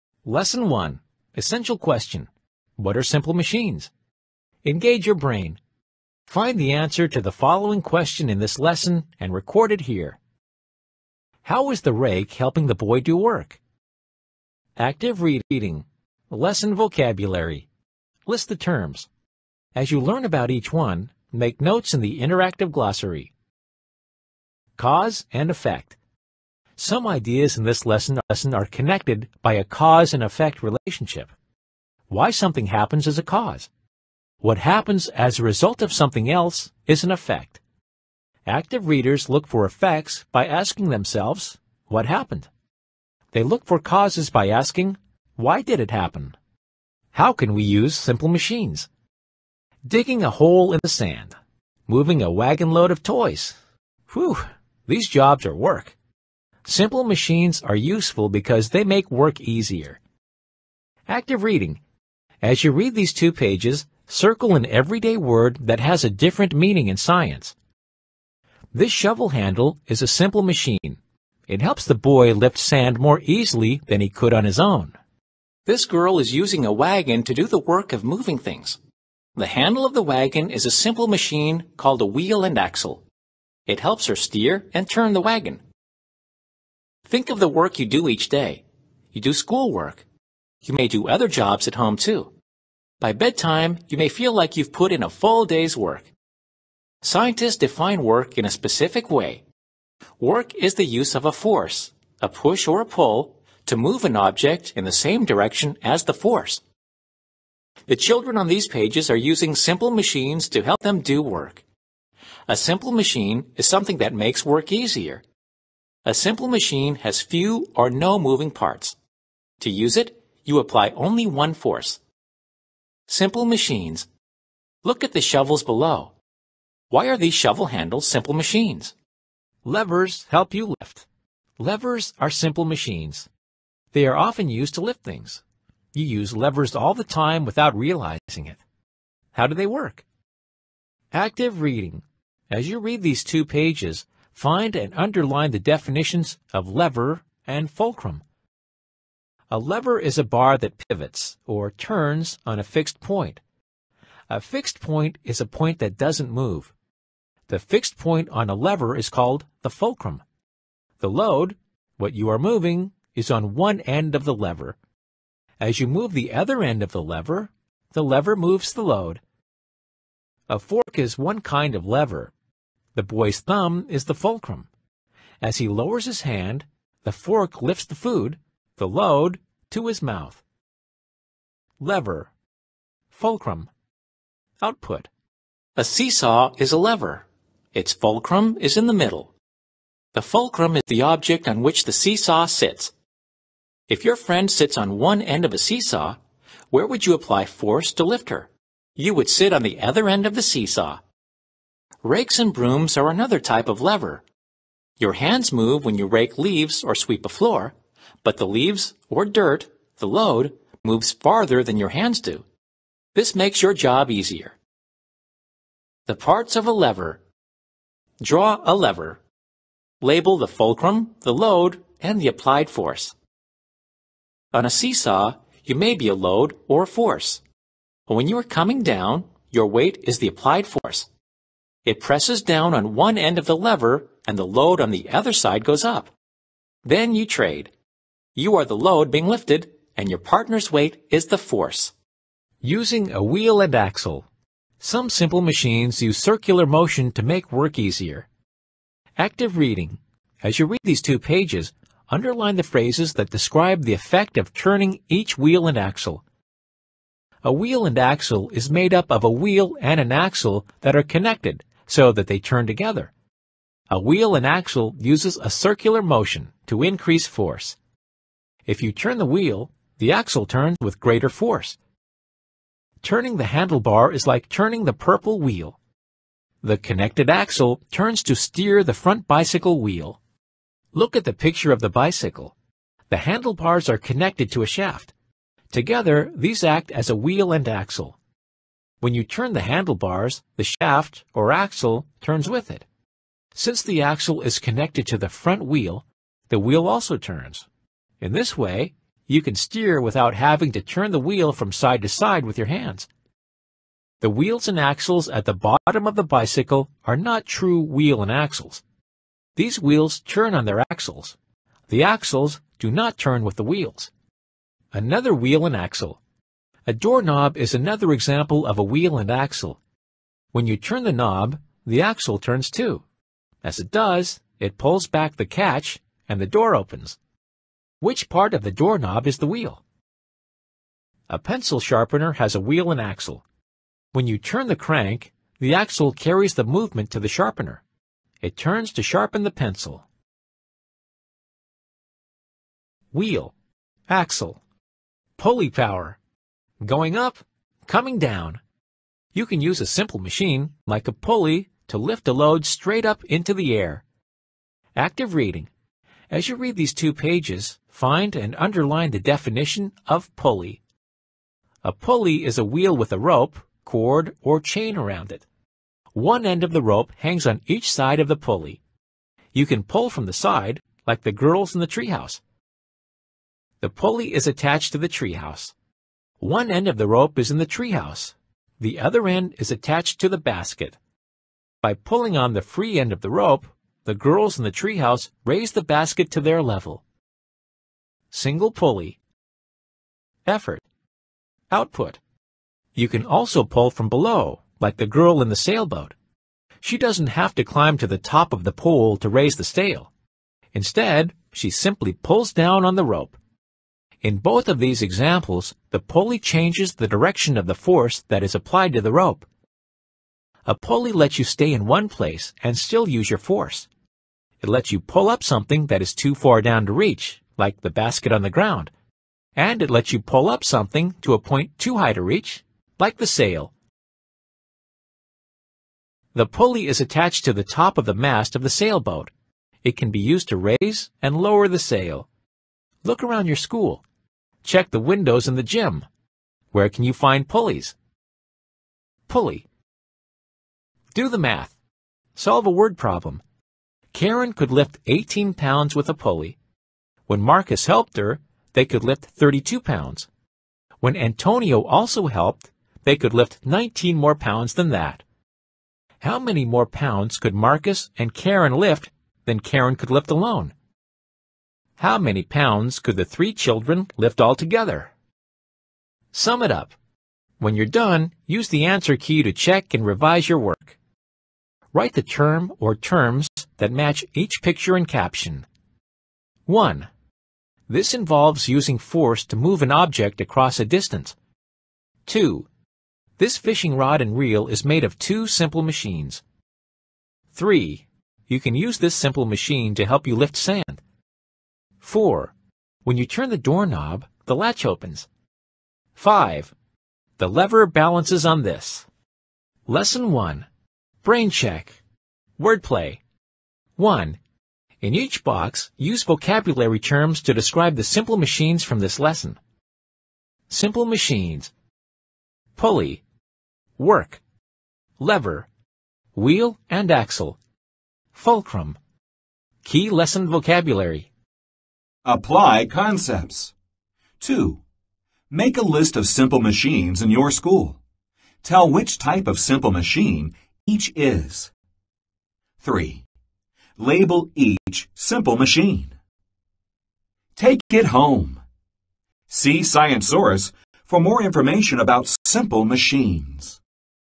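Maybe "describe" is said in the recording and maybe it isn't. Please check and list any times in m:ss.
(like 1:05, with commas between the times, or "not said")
4:13, 8:27.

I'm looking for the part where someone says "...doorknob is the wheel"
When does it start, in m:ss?
5:28.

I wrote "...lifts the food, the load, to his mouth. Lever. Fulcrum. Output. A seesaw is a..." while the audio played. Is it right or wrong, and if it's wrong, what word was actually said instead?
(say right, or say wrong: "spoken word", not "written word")
right.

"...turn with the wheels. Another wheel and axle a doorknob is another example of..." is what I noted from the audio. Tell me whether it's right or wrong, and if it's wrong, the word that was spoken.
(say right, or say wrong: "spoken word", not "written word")
right.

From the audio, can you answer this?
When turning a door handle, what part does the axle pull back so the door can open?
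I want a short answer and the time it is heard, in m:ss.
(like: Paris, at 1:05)
the catch, at 5:25.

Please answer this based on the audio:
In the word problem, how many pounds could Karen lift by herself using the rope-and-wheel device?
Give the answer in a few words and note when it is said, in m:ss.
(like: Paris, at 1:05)
18, at 7:25.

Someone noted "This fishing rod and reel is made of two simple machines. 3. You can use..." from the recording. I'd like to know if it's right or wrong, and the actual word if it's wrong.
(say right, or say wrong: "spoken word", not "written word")
right.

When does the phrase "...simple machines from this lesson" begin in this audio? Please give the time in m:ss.
8:28.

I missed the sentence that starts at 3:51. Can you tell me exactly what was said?
It presses down on one end of the lever and the load on the other side goes up.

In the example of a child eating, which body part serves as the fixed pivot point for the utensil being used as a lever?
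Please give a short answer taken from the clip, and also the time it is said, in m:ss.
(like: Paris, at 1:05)
thumb, at 2:52.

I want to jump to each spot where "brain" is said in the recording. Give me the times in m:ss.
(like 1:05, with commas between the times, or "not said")
0:05, 8:21.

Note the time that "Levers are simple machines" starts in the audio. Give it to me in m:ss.
2:11.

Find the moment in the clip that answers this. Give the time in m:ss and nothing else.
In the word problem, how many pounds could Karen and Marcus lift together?
7:29.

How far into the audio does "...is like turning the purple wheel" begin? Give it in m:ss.
4:34.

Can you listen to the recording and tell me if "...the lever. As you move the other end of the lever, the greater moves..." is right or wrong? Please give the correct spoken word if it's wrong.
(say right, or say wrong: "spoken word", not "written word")
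wrong: "lever", not "greater".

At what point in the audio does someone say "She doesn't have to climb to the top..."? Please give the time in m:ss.
6:36.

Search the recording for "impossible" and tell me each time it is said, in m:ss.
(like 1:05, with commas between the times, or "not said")
not said.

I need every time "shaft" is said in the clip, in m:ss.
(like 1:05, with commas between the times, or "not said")
4:44, 4:50.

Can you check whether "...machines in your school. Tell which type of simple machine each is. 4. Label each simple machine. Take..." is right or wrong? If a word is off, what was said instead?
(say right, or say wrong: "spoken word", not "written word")
wrong: "3", not "4".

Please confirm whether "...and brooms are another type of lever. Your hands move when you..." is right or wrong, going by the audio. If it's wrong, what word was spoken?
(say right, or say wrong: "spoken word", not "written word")
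right.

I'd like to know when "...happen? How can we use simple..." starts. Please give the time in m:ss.
0:45.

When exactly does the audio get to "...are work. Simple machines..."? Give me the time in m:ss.
0:55.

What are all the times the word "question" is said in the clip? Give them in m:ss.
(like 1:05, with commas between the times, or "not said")
0:01, 0:07.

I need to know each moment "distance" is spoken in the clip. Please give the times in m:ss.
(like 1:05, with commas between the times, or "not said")
8:00.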